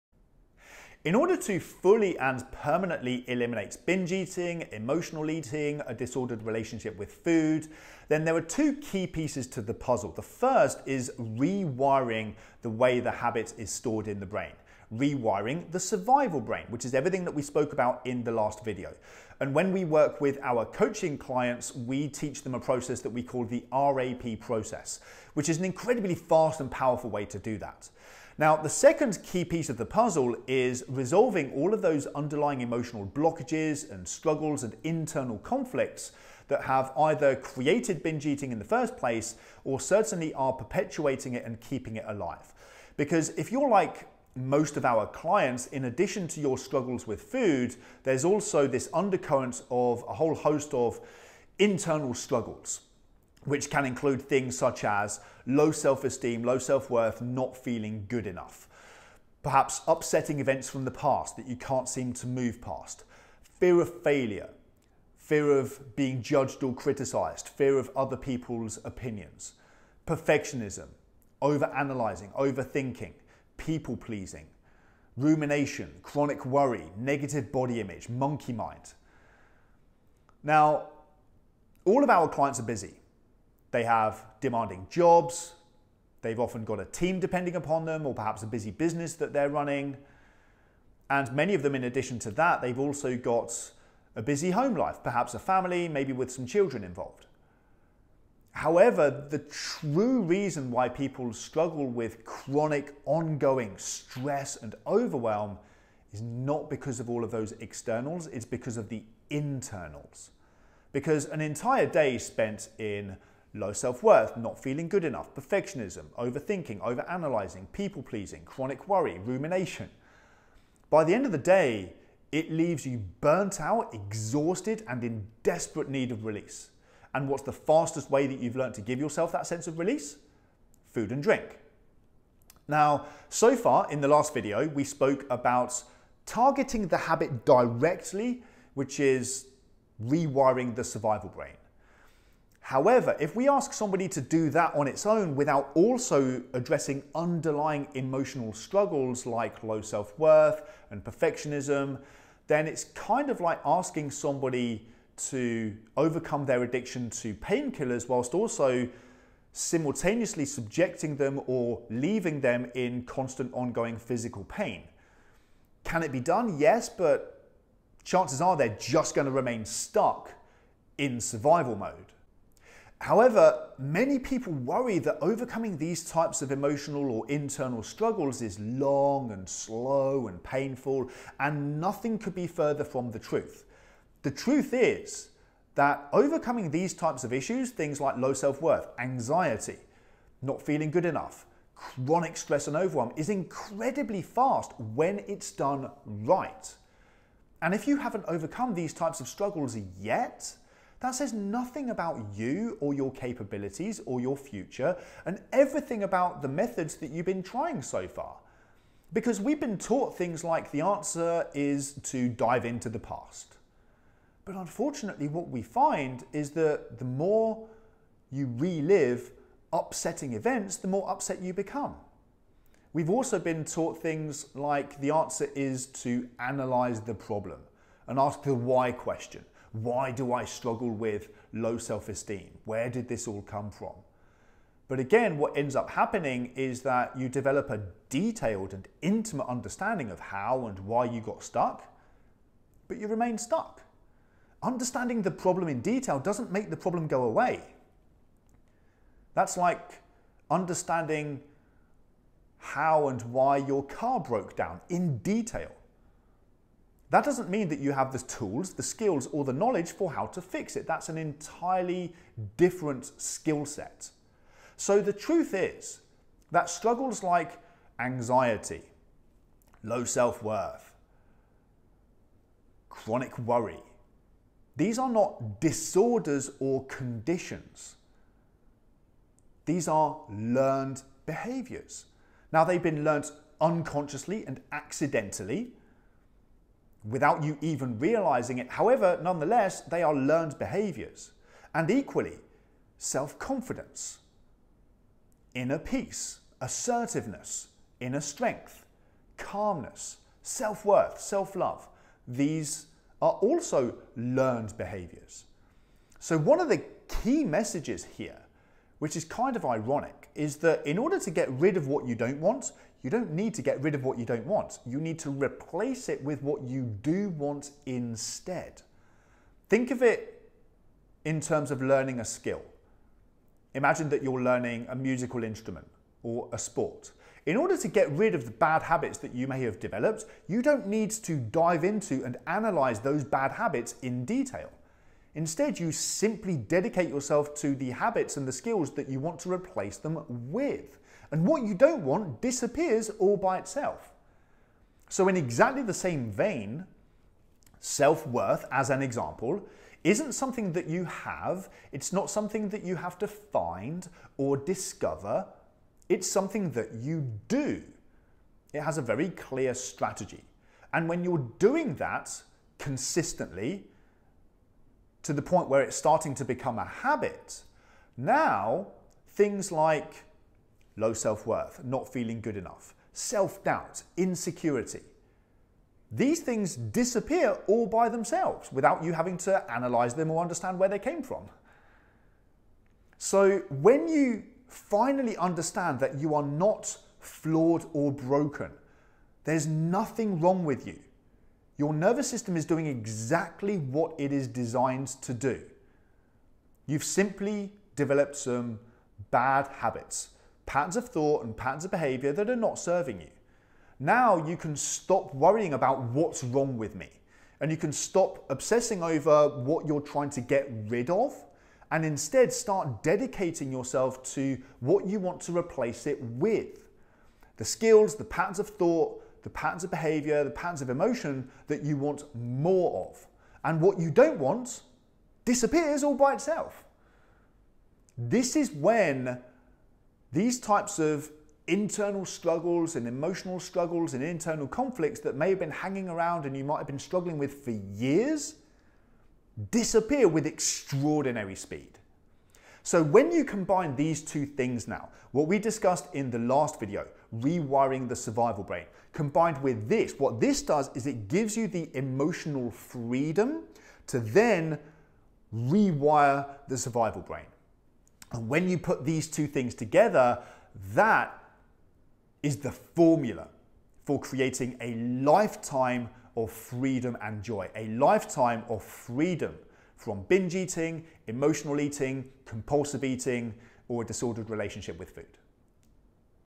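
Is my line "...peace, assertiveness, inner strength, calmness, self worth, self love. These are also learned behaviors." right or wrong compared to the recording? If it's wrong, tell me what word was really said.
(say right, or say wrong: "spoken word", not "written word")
right.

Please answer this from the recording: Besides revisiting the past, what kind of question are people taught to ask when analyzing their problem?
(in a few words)
The why question.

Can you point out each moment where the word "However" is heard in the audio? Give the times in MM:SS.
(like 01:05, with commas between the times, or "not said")
01:38, 02:22, 02:53, 04:48.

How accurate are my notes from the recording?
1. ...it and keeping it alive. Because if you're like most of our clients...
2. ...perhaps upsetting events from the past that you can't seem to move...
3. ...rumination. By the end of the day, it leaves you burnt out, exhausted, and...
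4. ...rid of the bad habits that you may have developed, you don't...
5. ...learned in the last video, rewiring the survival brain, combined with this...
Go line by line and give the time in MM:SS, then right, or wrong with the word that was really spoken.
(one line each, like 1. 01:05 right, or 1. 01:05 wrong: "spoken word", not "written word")
1. 00:41 right
2. 00:59 right
3. 01:59 right
4. 05:28 right
5. 07:25 wrong: "discussed", not "learned".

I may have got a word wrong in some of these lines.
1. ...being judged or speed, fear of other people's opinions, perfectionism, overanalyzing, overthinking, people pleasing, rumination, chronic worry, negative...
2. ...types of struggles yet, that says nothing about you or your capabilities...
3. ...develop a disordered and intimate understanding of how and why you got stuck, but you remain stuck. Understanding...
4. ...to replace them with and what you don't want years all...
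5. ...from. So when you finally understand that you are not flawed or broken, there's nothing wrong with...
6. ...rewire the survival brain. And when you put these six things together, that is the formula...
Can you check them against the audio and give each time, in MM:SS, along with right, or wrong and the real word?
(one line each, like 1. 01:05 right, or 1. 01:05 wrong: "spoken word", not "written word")
1. 01:05 wrong: "criticized", not "speed"
2. 03:18 right
3. 03:57 wrong: "detailed", not "disordered"
4. 05:39 wrong: "disappears", not "years"
5. 06:21 right
6. 07:35 wrong: "two", not "six".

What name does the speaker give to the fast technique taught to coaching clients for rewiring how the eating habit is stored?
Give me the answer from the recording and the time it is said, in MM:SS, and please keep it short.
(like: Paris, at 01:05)
RAP process, at 00:23.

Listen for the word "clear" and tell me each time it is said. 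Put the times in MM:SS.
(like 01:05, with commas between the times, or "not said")
05:59.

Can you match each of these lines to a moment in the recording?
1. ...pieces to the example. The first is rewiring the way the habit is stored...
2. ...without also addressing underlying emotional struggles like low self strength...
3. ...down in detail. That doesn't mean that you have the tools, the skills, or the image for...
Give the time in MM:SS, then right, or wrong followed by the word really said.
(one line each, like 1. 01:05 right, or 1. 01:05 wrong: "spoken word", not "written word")
1. 00:09 wrong: "puzzle", not "example"
2. 02:25 wrong: "worth", not "strength"
3. 04:14 wrong: "knowledge", not "image".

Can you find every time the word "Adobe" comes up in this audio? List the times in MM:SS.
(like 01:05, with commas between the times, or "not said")
not said.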